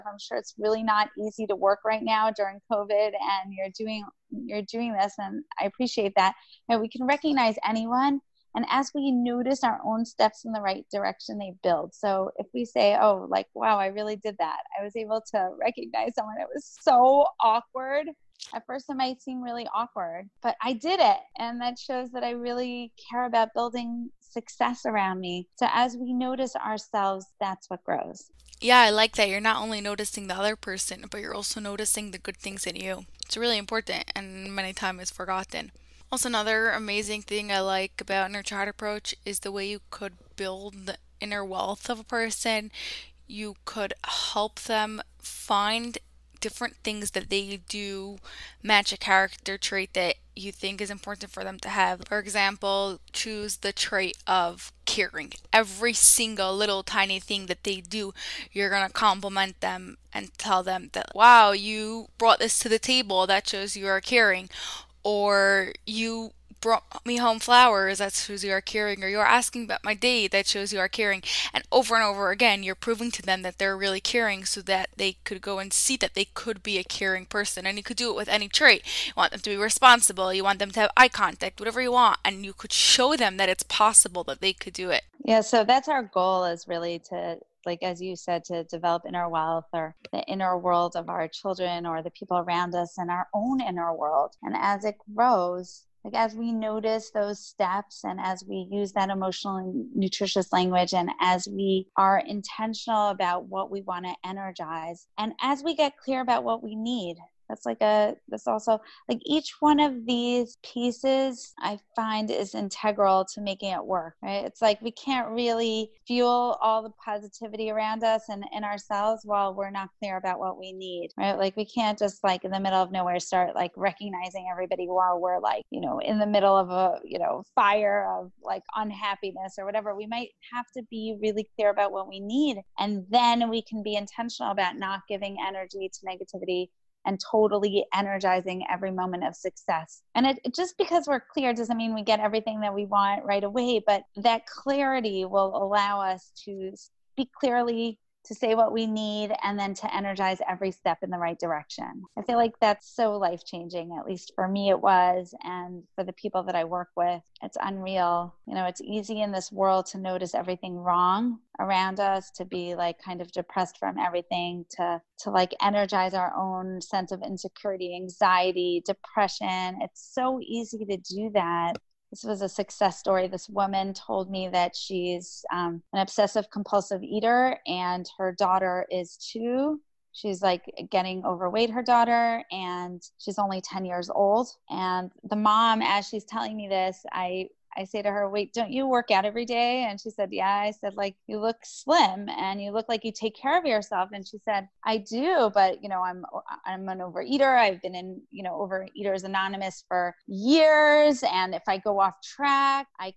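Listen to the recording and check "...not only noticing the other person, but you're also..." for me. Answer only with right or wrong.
right.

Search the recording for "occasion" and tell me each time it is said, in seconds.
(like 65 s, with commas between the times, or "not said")
not said.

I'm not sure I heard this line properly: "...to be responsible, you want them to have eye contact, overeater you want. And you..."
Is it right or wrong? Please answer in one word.
wrong.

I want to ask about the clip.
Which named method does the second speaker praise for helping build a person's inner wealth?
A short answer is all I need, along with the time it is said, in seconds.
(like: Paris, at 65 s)
Inner Child Approach, at 38 s.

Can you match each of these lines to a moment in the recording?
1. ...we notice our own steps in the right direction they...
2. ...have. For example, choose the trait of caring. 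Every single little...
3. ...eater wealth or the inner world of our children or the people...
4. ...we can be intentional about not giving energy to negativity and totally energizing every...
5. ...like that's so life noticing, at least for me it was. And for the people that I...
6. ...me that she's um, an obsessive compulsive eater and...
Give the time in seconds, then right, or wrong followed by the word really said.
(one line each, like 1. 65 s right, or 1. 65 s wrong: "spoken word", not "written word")
1. 8 s right
2. 51 s right
3. 89 s wrong: "inner", not "eater"
4. 133 s right
5. 152 s wrong: "changing", not "noticing"
6. 174 s right.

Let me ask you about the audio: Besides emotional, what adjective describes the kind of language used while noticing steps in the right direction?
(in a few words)
nutritious.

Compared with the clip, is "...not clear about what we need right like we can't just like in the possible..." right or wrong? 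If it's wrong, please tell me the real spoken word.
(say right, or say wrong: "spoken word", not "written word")
wrong: "middle", not "possible".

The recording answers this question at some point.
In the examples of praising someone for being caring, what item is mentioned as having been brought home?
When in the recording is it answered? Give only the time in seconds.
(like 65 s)
67 s.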